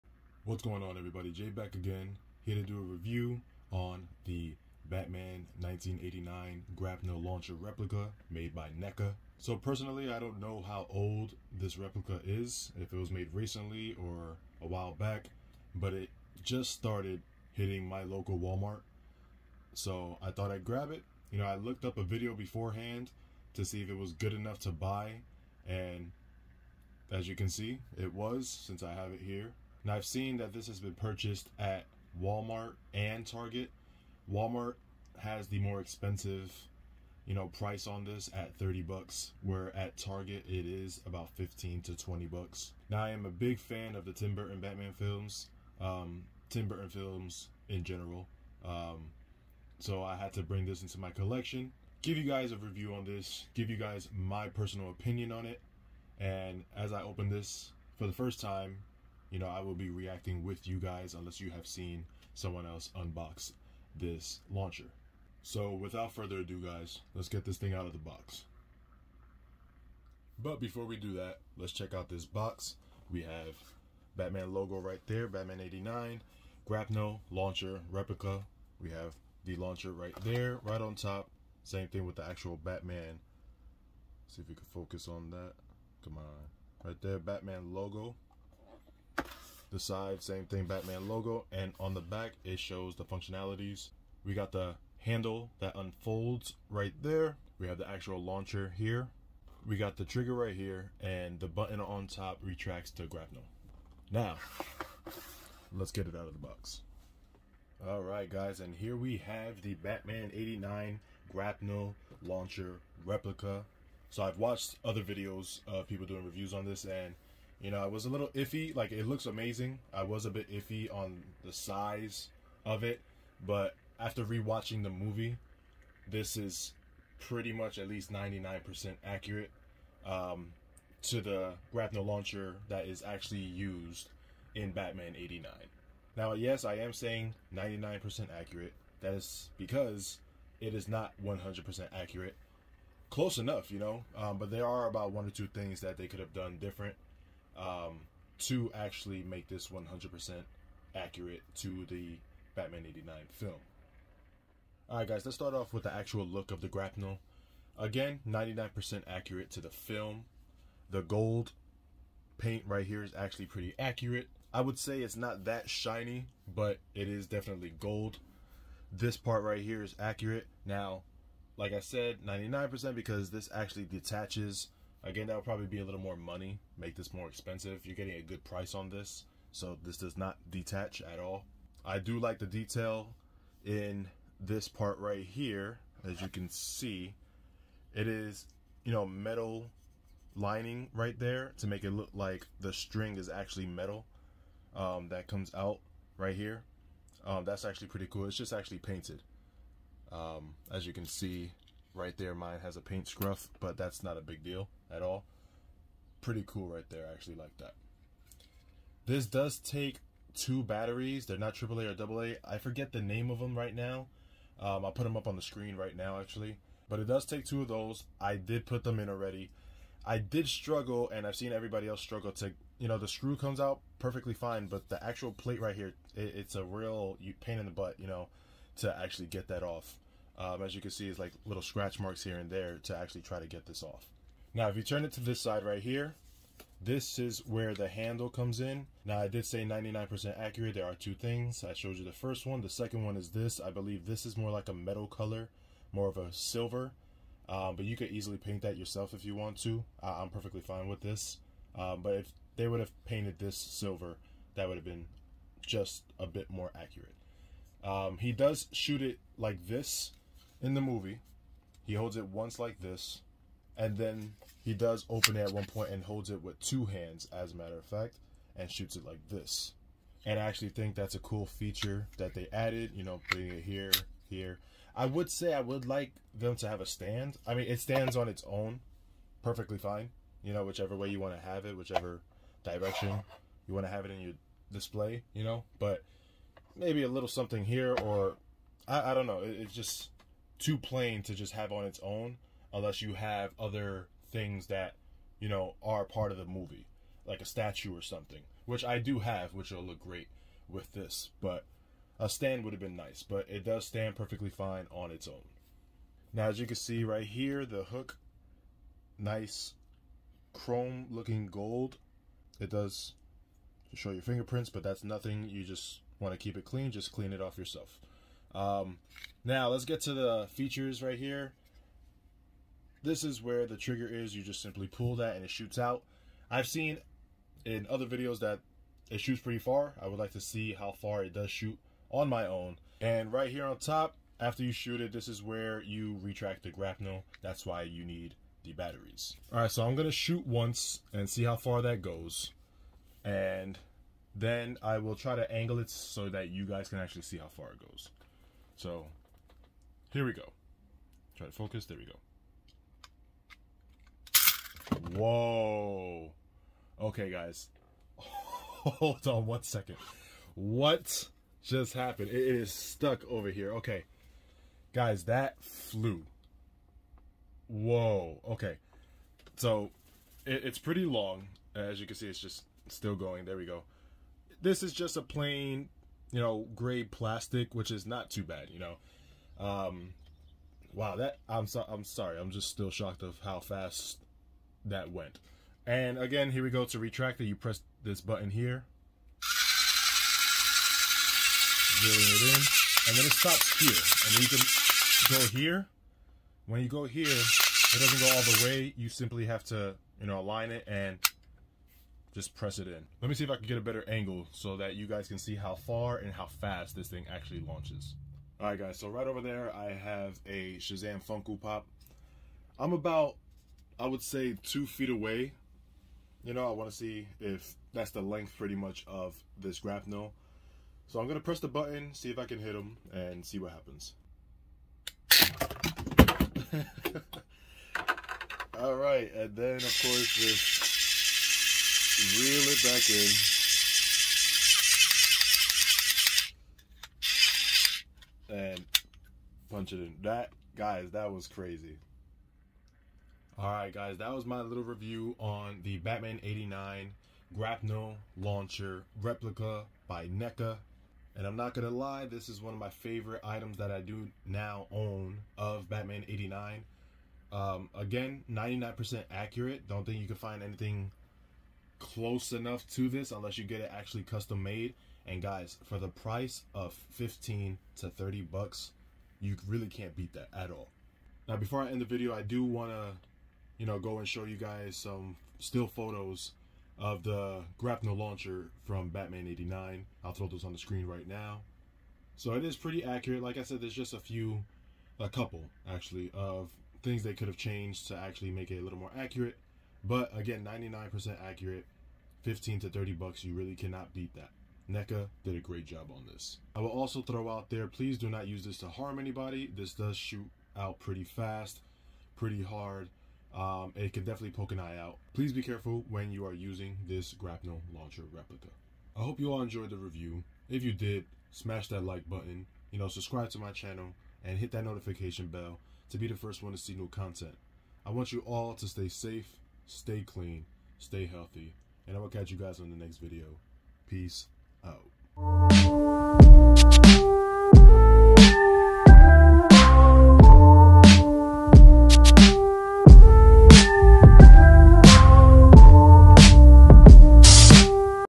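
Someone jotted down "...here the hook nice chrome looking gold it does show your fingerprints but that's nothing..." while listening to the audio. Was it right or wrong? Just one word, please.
right.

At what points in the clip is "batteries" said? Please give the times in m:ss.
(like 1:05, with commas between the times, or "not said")
3:30, 5:38.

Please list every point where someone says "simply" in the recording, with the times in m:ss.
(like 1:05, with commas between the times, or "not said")
5:24, 6:39.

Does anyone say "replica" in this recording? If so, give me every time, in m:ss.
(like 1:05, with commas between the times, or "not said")
0:07, 0:11, 1:17, 1:53, 7:29, 8:28.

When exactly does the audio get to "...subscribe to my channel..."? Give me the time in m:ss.
8:33.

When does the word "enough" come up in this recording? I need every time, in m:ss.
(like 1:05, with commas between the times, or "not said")
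0:24, 2:23, 7:42.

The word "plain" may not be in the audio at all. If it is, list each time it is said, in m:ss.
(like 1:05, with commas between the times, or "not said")
4:50, 6:15.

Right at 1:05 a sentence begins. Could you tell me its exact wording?
So without further ado, guys, let's get this thing out of the box.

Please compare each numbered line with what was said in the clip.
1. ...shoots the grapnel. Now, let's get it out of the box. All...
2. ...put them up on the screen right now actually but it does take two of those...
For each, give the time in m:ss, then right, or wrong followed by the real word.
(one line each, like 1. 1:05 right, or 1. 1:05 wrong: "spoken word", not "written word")
1. 1:42 wrong: "retracts", not "shoots"
2. 3:34 right.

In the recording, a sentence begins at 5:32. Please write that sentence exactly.
And right here on top, after you shoot it, this is where you retract the grapnel.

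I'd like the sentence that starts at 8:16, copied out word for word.
I will also throw out there, please do not use this to harm anybody.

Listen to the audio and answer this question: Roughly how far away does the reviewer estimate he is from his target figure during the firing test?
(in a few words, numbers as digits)
2 feet.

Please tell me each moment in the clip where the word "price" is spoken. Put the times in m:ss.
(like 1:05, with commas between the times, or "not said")
0:37, 2:58, 7:46.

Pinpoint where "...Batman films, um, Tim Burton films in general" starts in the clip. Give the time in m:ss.
0:44.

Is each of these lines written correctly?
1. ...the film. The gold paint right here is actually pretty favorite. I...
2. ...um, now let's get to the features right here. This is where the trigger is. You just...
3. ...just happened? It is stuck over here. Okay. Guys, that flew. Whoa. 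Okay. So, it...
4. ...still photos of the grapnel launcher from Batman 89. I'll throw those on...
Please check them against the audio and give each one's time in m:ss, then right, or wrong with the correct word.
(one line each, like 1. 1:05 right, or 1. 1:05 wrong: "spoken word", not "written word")
1. 2:39 wrong: "accurate", not "favorite"
2. 5:18 right
3. 6:01 right
4. 7:55 right.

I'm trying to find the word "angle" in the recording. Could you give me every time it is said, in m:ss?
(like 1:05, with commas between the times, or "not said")
5:45, 6:44.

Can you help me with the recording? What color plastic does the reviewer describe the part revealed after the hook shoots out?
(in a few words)
Gray.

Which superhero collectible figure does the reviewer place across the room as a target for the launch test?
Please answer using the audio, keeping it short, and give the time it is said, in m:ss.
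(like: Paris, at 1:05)
Shazam Funko Pop, at 6:50.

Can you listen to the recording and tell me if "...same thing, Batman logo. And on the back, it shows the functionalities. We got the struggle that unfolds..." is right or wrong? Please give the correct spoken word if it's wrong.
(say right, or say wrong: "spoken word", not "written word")
wrong: "handle", not "struggle".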